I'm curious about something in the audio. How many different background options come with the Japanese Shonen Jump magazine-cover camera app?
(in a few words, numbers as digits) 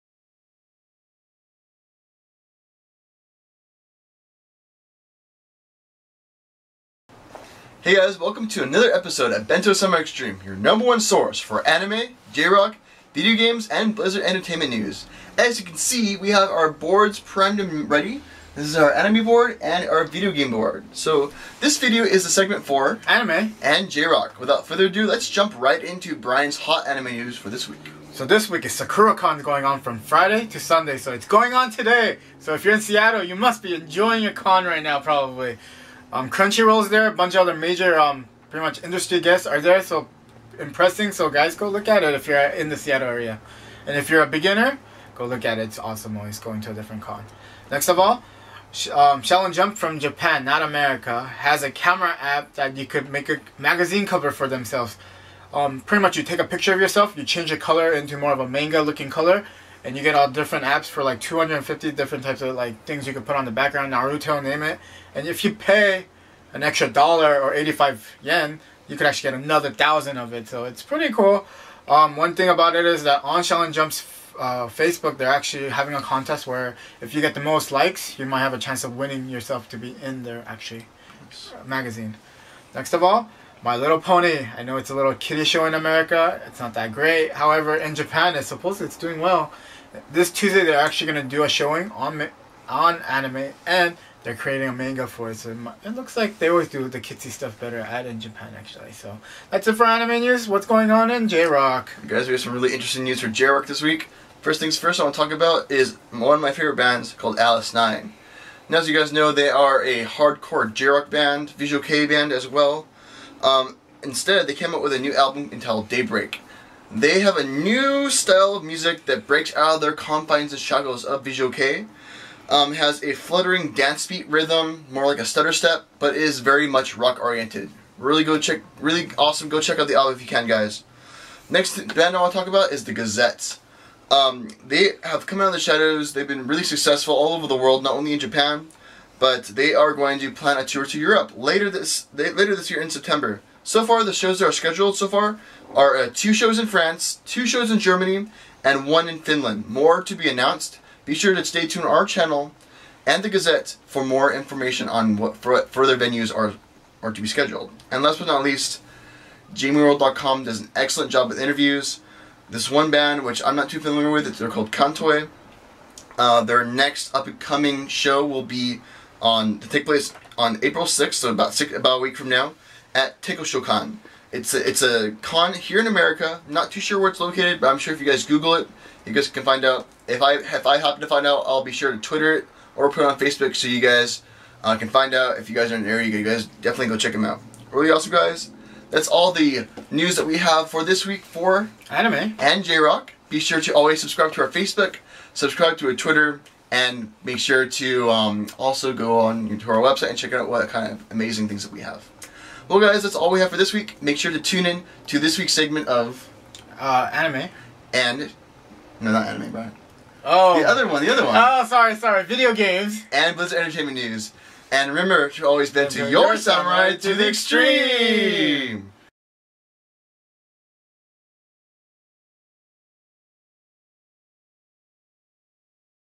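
250.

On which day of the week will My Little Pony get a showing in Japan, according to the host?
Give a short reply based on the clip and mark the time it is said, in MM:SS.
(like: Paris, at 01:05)
Tuesday, at 01:30.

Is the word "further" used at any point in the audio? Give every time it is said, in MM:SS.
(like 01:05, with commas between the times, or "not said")
00:24, 02:35.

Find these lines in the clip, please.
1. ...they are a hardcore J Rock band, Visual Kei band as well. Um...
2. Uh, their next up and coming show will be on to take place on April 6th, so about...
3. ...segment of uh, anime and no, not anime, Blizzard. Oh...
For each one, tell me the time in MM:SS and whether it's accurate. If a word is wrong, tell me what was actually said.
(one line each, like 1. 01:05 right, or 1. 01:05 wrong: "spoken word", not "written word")
1. 01:49 right
2. 02:46 right
3. 03:25 wrong: "Brian", not "Blizzard".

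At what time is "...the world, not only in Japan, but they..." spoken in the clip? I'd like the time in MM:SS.
02:17.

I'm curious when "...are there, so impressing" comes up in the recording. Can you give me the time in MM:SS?
00:39.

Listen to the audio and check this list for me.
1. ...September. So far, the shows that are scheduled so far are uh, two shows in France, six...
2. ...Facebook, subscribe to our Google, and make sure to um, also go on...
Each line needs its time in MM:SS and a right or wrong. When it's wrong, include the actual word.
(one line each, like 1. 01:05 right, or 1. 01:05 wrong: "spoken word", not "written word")
1. 02:22 wrong: "two", not "six"
2. 03:14 wrong: "Twitter", not "Google".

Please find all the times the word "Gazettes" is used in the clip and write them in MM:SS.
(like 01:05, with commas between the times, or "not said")
02:12, 02:33.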